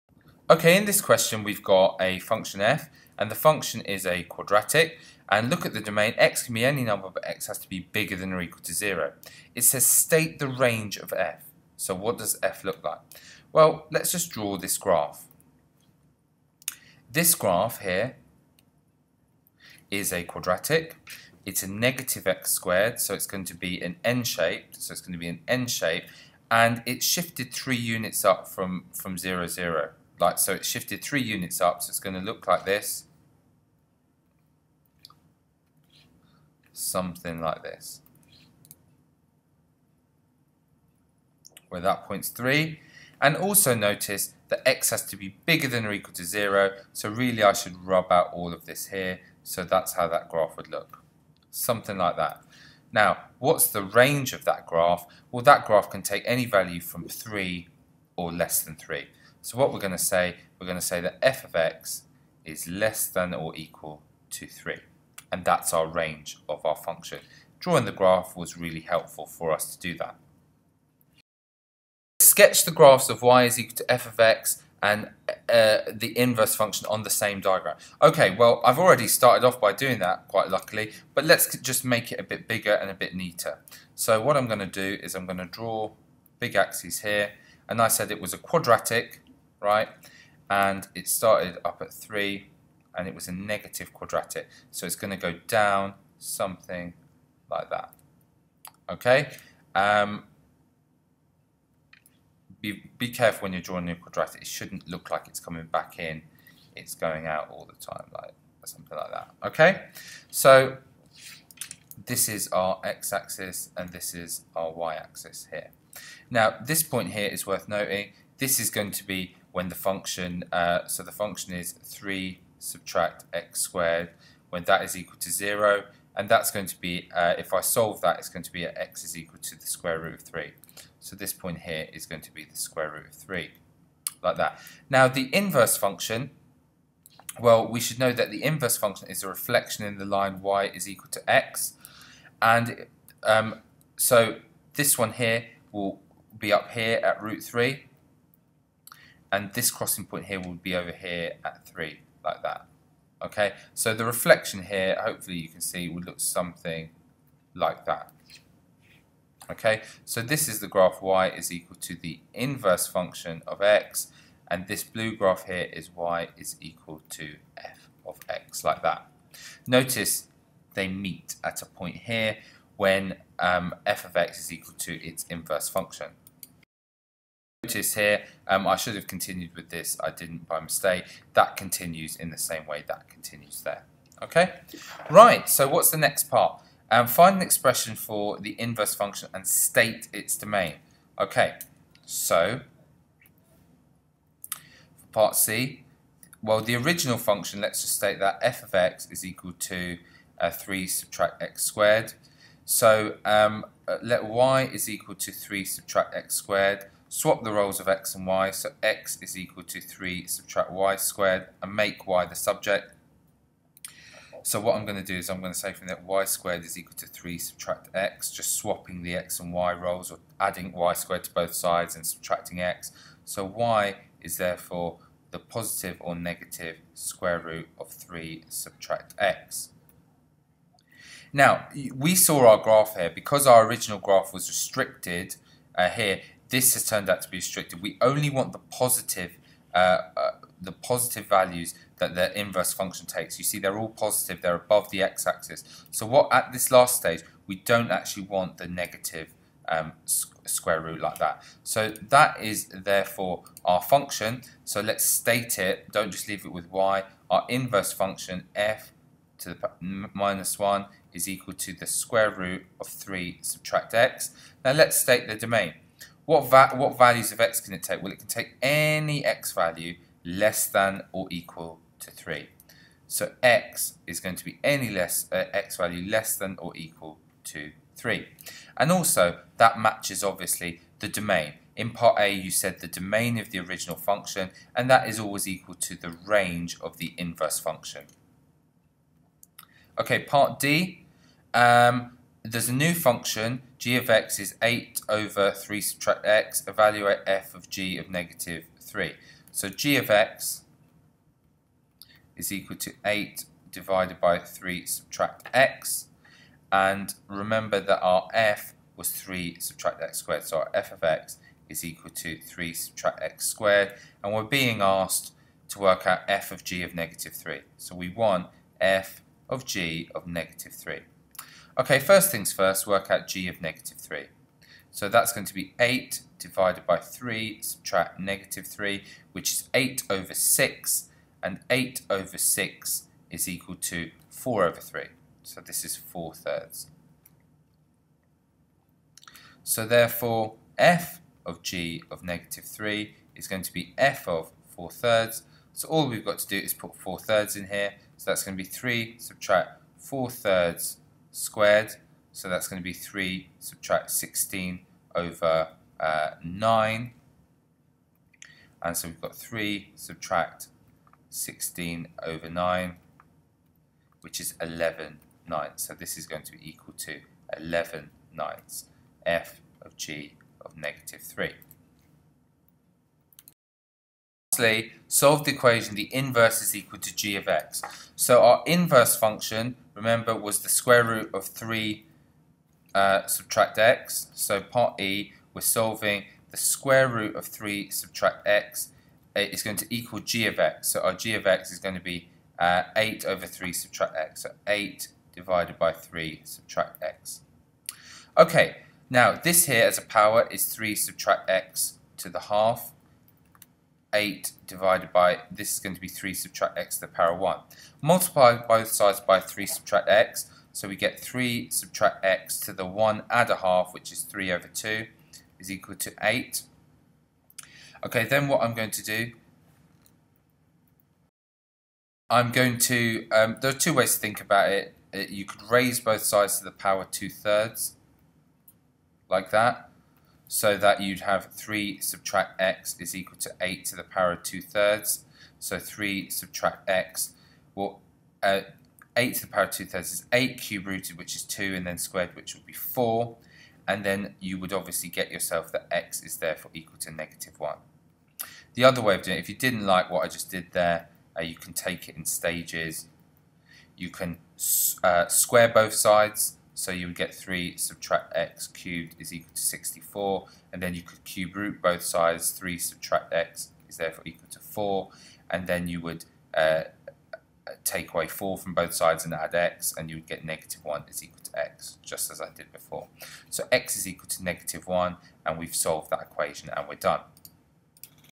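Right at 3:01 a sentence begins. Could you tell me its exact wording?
That continues in the same way that continues there.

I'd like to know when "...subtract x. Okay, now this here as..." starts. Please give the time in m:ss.
6:36.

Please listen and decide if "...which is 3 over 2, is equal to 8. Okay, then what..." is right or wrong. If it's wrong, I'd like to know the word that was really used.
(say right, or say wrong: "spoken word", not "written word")
right.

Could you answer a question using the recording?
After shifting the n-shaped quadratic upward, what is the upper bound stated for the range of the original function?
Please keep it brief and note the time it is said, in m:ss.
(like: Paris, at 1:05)
3, at 1:01.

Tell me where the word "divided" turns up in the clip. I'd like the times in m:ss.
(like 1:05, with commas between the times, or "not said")
5:03, 5:26, 6:35, 6:44.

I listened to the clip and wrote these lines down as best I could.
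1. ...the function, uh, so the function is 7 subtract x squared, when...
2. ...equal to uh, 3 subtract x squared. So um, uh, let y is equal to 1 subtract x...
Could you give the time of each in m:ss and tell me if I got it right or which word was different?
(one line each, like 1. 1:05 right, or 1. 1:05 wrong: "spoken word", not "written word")
1. 1:59 wrong: "3", not "7"
2. 3:19 wrong: "3", not "1".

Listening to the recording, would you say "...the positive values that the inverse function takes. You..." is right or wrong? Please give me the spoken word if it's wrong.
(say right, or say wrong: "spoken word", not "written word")
right.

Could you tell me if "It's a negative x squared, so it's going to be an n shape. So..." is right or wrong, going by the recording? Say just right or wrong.
right.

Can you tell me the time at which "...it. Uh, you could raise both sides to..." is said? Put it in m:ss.
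7:04.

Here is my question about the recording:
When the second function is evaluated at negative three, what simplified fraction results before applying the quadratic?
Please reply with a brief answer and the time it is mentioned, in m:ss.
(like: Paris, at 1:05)
4/3, at 5:34.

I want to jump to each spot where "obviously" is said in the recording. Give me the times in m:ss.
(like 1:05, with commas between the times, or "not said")
4:40, 7:24.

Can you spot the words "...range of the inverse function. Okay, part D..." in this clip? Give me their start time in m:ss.
4:46.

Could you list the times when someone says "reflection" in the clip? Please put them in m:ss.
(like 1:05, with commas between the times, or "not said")
2:19, 2:34.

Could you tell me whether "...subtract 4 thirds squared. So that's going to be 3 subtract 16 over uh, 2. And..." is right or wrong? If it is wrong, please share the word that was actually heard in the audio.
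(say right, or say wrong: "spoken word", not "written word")
wrong: "9", not "2".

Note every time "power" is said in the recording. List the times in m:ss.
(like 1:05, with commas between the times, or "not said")
6:40, 6:47, 7:06, 7:14, 7:19.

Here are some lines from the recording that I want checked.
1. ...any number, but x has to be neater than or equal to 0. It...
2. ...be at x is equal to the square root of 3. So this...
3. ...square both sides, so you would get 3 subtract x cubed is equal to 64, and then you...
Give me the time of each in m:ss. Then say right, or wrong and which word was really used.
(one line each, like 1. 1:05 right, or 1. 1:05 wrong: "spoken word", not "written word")
1. 0:06 wrong: "bigger", not "neater"
2. 2:08 right
3. 7:35 right.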